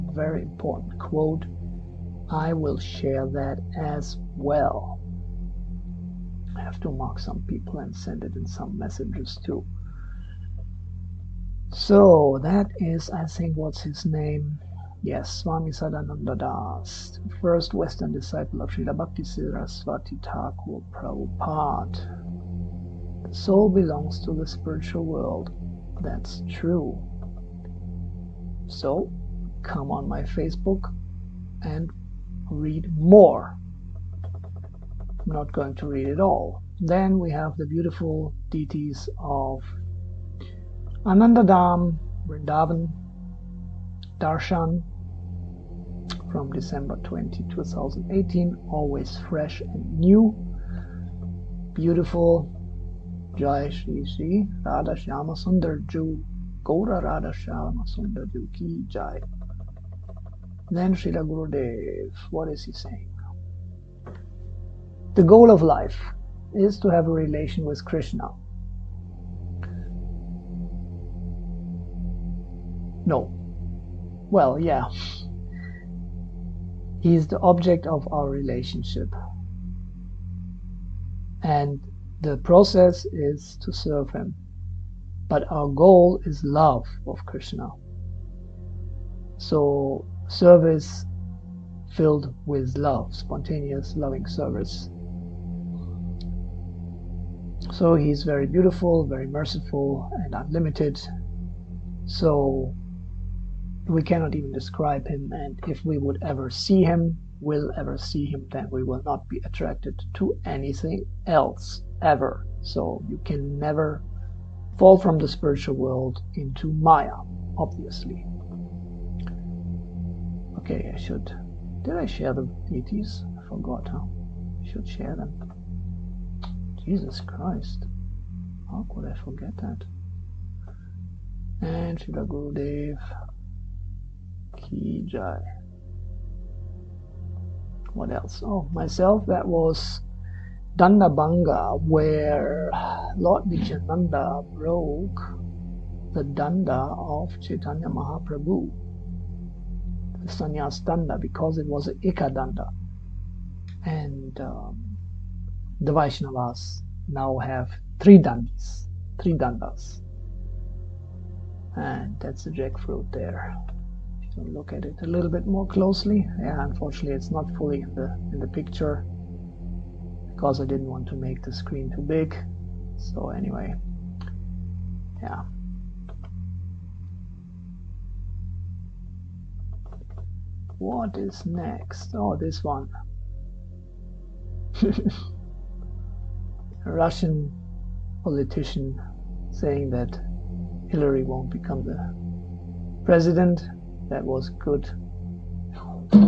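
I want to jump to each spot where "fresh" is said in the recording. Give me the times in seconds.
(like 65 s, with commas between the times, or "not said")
49 s.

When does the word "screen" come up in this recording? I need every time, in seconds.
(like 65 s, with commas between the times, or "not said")
171 s.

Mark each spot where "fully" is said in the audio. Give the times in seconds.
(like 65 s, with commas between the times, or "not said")
167 s.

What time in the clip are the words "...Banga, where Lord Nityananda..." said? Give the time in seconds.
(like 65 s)
140 s.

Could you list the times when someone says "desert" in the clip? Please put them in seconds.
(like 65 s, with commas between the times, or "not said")
not said.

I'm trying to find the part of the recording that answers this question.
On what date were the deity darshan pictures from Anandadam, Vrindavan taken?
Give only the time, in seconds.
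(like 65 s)
46 s.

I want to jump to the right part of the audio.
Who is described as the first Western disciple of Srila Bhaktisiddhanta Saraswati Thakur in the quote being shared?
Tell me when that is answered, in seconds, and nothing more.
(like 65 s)
15 s.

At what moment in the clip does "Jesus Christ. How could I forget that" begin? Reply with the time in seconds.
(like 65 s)
126 s.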